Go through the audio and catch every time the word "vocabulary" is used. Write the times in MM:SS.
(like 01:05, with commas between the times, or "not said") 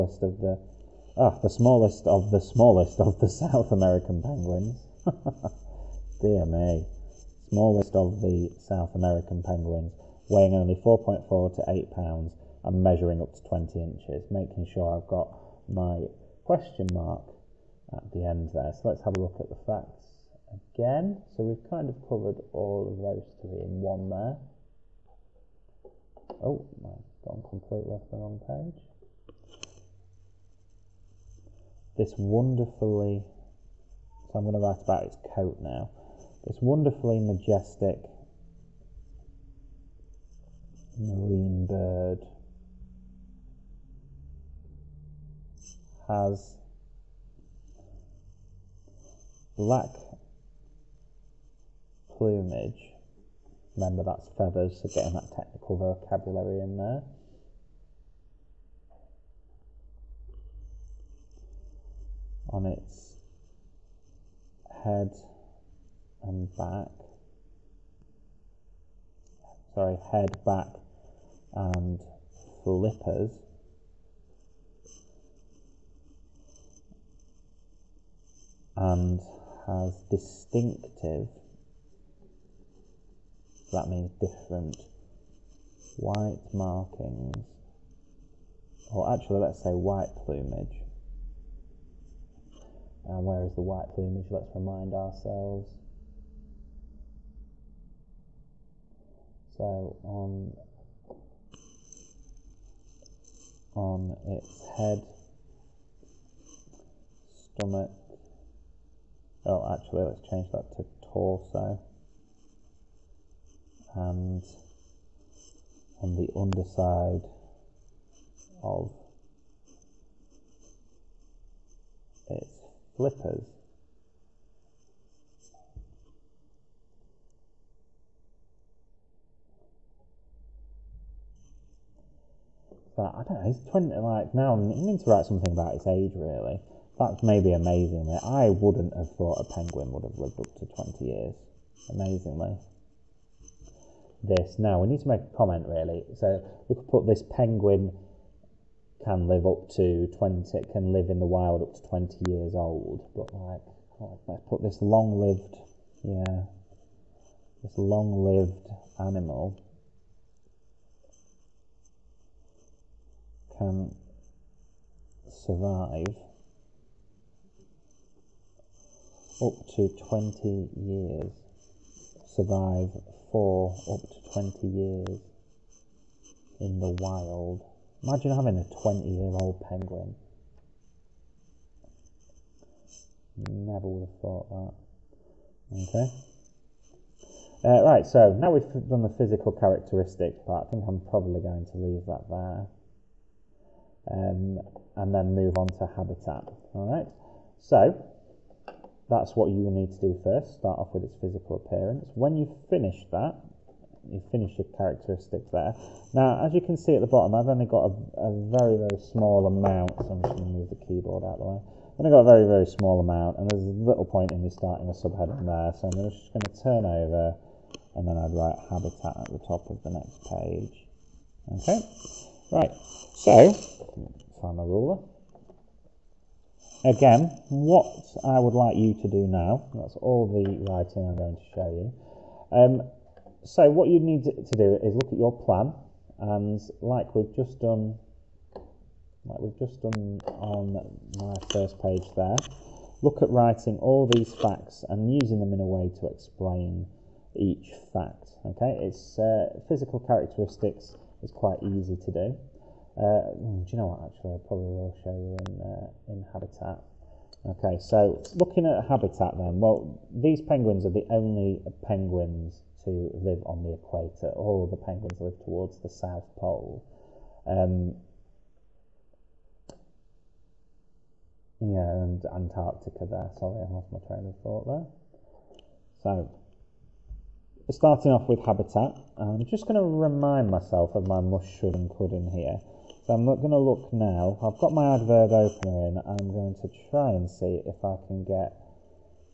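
00:55.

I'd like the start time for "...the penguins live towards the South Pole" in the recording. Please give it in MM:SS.
04:24.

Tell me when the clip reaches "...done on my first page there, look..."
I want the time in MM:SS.
03:59.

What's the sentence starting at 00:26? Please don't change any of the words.
Oh, I've gone completely off the wrong page.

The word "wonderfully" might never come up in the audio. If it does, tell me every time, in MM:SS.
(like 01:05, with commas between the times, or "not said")
00:32, 00:36.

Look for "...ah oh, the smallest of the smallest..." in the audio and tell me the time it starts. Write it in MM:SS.
00:01.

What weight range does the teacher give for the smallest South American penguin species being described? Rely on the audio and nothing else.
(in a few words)
4.4 to 8 pounds.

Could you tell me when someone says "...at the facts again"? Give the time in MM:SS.
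00:19.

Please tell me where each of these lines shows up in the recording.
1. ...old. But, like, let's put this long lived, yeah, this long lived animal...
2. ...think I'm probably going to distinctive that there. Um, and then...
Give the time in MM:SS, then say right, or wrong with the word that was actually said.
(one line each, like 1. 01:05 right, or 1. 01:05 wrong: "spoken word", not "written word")
1. 02:32 right
2. 03:10 wrong: "leave", not "distinctive".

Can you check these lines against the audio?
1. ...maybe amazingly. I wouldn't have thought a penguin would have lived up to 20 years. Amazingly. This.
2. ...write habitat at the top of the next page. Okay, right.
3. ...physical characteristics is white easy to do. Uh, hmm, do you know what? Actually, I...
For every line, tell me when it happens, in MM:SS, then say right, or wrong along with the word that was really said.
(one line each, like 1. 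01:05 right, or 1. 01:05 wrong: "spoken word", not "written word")
1. 02:17 right
2. 03:38 right
3. 04:09 wrong: "quite", not "white".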